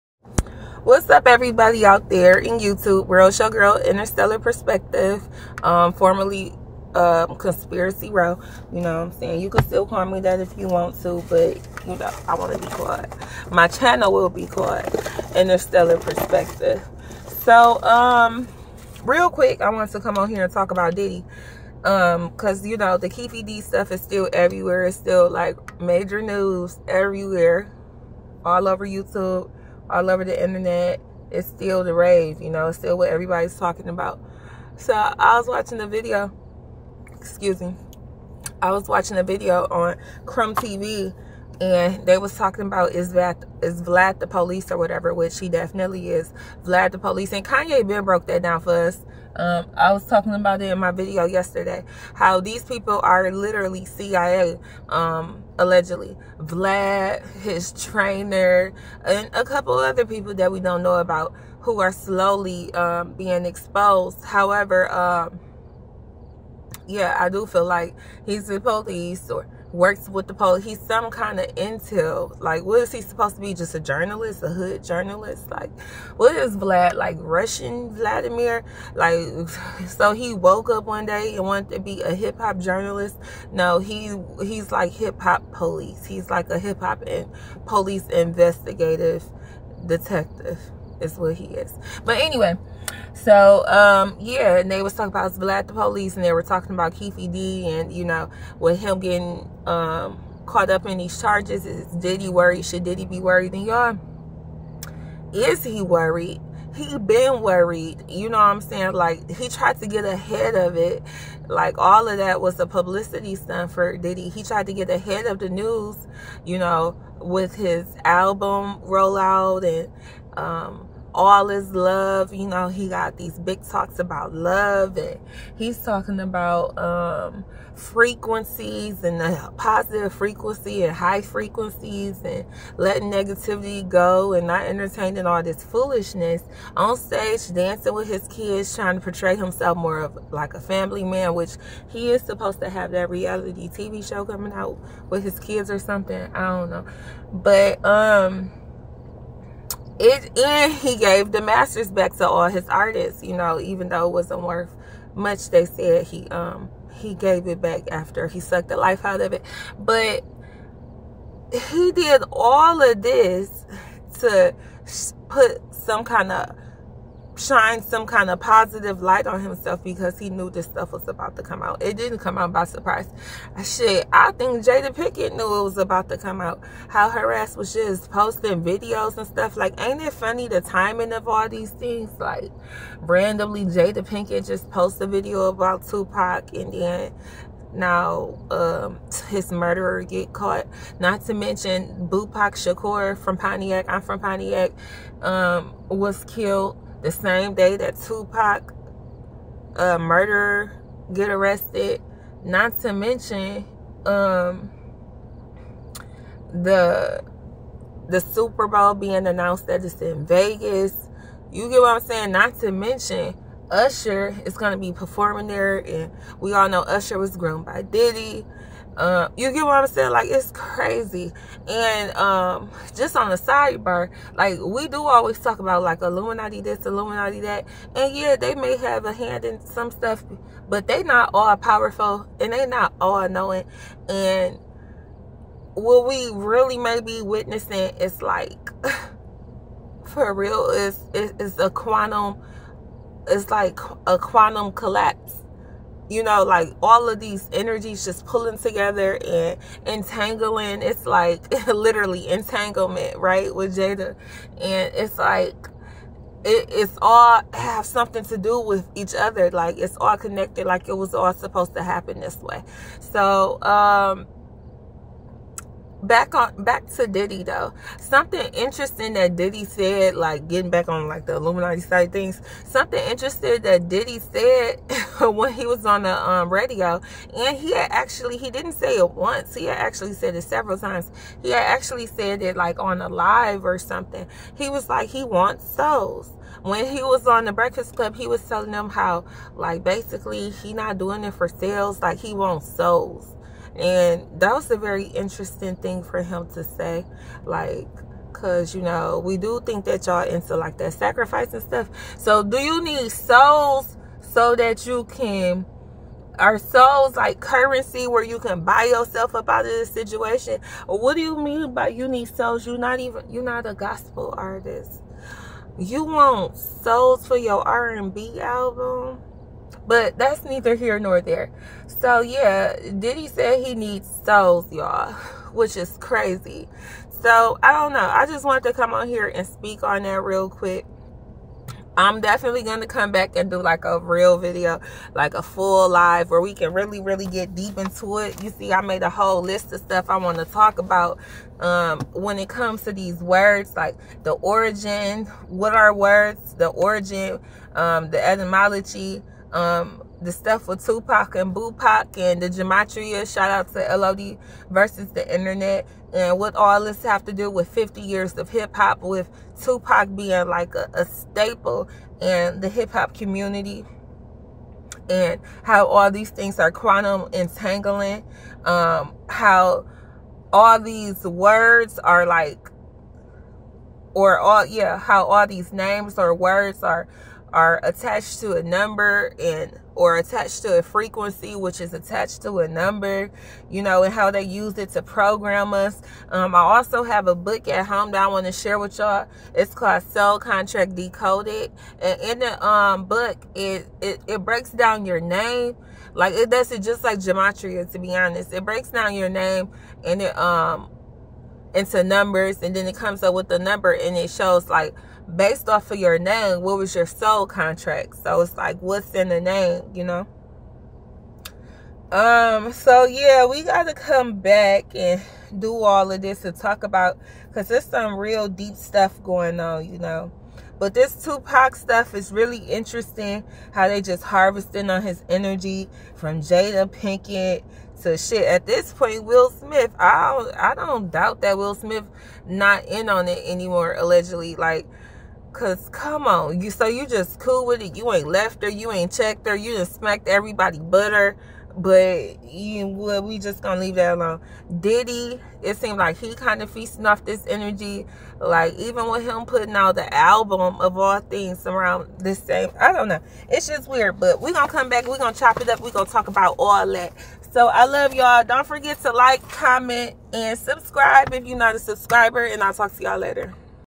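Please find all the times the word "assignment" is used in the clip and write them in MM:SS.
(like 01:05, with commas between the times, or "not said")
not said.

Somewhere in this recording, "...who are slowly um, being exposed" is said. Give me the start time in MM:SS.
01:01.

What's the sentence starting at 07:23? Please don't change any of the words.
we just gonna leave that alone.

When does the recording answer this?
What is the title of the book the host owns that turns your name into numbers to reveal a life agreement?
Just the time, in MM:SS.
06:30.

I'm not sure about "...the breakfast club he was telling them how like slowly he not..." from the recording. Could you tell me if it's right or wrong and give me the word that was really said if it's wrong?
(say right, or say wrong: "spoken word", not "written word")
wrong: "basically", not "slowly".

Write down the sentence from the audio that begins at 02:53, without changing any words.
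Shit, I think Jada Pinkett knew it was about to come out.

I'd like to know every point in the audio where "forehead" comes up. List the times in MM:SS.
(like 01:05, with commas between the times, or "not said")
not said.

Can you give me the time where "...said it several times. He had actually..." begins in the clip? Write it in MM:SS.
04:40.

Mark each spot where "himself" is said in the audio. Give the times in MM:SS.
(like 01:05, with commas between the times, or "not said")
02:19, 02:49.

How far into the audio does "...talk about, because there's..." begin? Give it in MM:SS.
06:56.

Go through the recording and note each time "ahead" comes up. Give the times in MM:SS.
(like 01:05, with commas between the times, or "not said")
01:50, 01:54.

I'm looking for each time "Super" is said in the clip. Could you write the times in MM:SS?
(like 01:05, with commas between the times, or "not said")
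03:28.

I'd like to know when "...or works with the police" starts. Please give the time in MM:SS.
01:09.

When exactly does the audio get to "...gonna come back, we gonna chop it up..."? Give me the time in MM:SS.
07:34.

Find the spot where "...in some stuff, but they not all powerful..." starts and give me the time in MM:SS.
03:49.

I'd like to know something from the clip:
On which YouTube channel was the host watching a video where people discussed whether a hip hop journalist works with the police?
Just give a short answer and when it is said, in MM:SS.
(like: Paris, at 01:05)
Crumb TV, at 00:40.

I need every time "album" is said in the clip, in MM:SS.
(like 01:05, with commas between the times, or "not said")
01:58, 05:18, 07:30.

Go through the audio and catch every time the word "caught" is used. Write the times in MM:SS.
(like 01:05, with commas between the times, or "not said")
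01:40, 03:10.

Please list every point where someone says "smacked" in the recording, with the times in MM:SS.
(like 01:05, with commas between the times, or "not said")
07:19.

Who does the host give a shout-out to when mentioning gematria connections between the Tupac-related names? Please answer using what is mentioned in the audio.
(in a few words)
LOD versus the internet.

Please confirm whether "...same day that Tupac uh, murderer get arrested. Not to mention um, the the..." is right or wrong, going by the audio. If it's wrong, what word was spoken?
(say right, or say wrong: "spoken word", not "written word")
right.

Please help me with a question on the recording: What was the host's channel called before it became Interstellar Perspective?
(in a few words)
Conspiracy Row.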